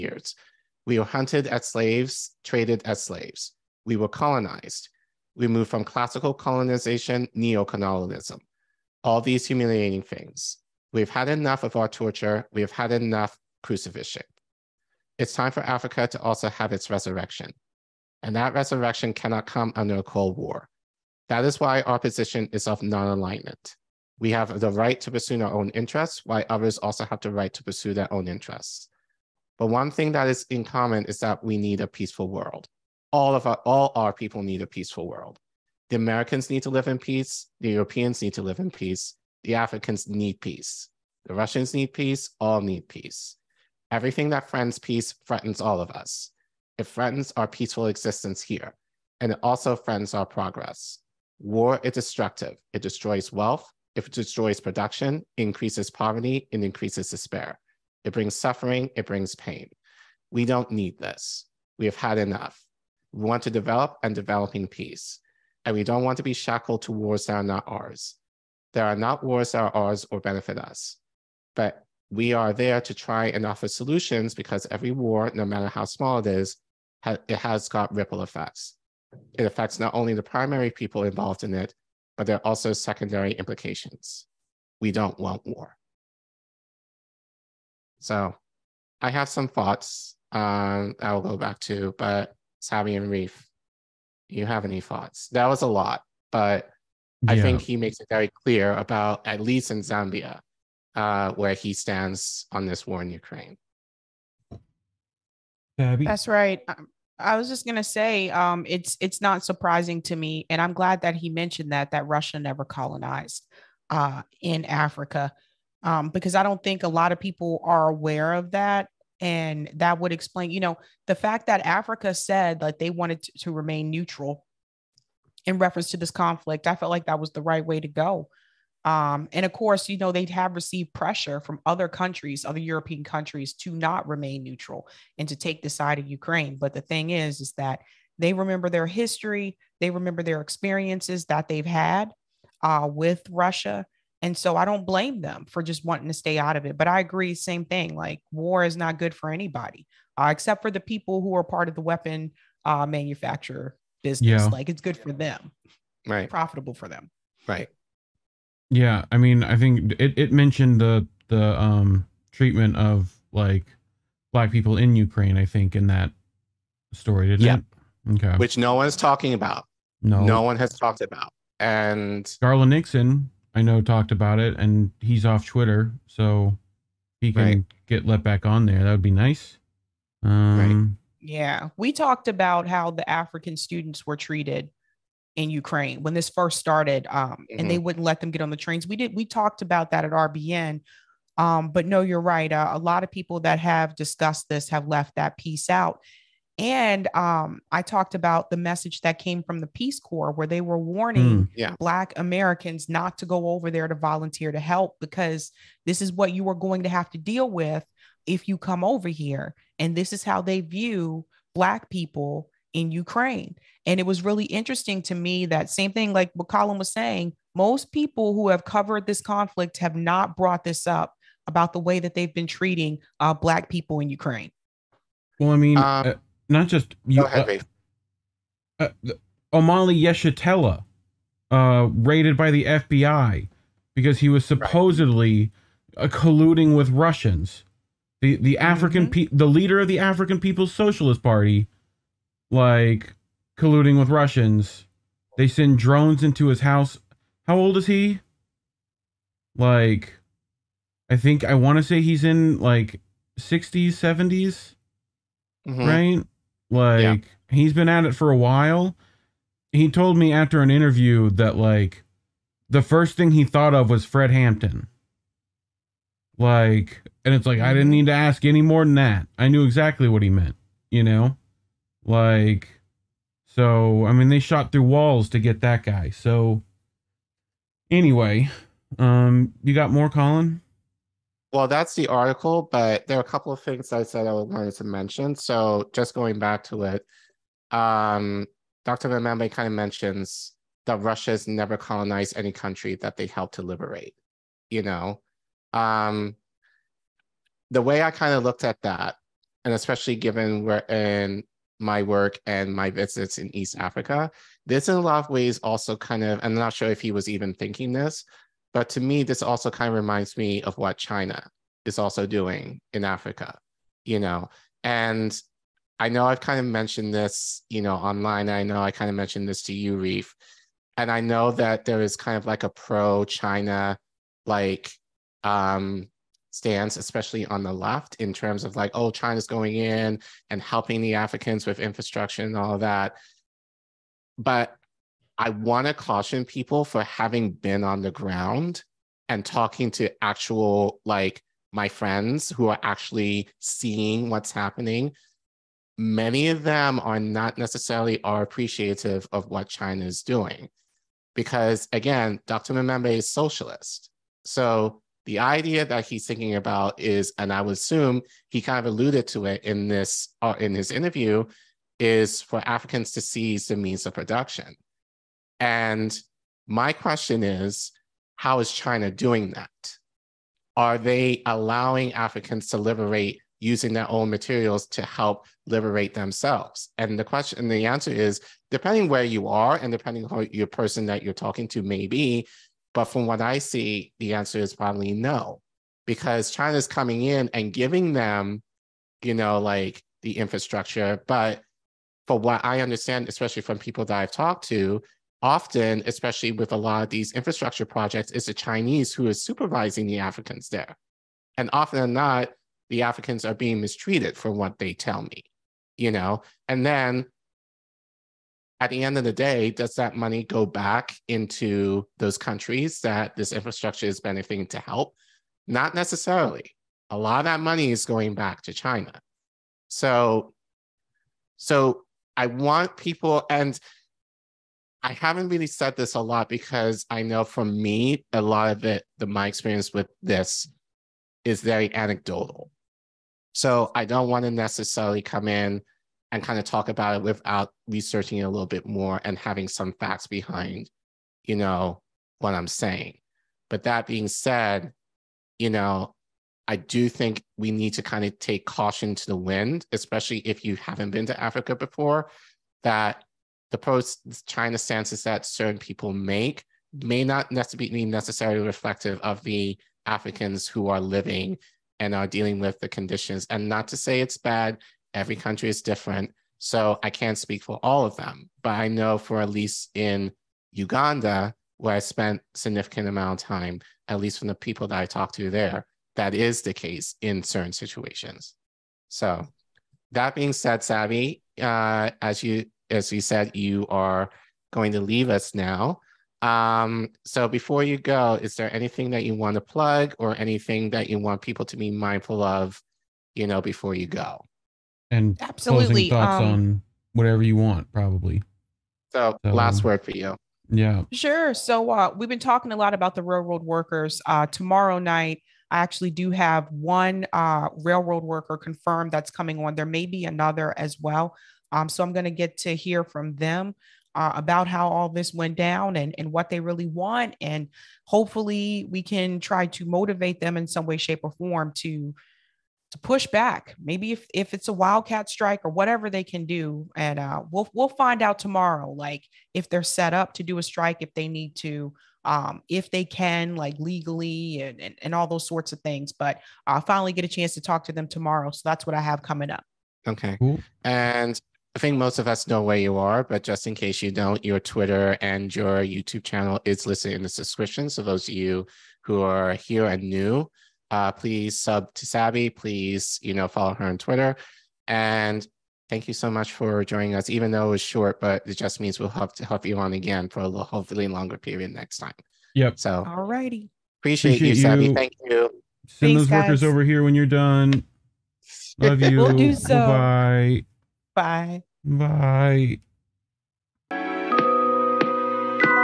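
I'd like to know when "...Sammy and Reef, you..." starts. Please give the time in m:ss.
1:32.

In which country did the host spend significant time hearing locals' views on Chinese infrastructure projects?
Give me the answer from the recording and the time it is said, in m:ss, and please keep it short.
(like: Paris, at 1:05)
Uganda, at 7:50.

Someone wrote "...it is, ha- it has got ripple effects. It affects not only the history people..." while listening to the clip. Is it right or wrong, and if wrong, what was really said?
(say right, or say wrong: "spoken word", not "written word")
wrong: "primary", not "history".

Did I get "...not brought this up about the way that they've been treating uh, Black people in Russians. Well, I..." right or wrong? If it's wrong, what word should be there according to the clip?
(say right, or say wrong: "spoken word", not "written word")
wrong: "Ukraine", not "Russians".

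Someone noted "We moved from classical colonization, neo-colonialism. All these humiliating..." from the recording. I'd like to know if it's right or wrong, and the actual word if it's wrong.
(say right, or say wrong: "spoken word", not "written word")
right.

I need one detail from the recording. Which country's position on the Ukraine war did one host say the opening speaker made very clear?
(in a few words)
Zambia.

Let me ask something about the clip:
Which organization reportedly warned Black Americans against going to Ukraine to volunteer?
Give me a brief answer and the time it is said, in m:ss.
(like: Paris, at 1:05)
Peace Corps, at 3:19.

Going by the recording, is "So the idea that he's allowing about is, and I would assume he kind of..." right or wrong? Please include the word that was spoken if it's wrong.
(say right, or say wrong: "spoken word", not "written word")
wrong: "thinking", not "allowing".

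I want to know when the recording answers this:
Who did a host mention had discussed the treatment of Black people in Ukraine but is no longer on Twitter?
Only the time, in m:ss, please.
2:52.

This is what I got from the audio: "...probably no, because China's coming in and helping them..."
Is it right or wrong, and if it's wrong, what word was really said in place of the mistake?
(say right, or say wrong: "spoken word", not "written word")
wrong: "giving", not "helping".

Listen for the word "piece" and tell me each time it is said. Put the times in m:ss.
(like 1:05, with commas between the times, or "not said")
3:15.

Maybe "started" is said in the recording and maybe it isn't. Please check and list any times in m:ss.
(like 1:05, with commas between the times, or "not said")
3:06.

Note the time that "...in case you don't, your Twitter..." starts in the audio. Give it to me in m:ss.
9:03.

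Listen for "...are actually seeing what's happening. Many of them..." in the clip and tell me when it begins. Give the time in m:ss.
5:42.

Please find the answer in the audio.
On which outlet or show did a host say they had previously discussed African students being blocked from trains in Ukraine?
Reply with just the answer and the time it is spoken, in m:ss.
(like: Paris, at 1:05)
RBN, at 3:10.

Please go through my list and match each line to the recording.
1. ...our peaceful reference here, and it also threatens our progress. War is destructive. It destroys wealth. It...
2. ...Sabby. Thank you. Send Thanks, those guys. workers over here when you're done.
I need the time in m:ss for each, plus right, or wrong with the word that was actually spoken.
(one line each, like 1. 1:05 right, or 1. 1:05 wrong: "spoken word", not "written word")
1. 0:47 wrong: "existence", not "reference"
2. 9:24 right.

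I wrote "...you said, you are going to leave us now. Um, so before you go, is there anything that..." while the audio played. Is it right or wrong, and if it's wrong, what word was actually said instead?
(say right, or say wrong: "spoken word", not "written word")
right.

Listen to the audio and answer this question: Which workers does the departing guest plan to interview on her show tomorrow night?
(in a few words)
Railroad workers.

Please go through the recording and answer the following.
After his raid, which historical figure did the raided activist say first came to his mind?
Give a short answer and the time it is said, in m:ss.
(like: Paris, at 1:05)
Fred Hampton, at 4:24.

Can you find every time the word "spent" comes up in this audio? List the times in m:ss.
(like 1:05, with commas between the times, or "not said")
7:51.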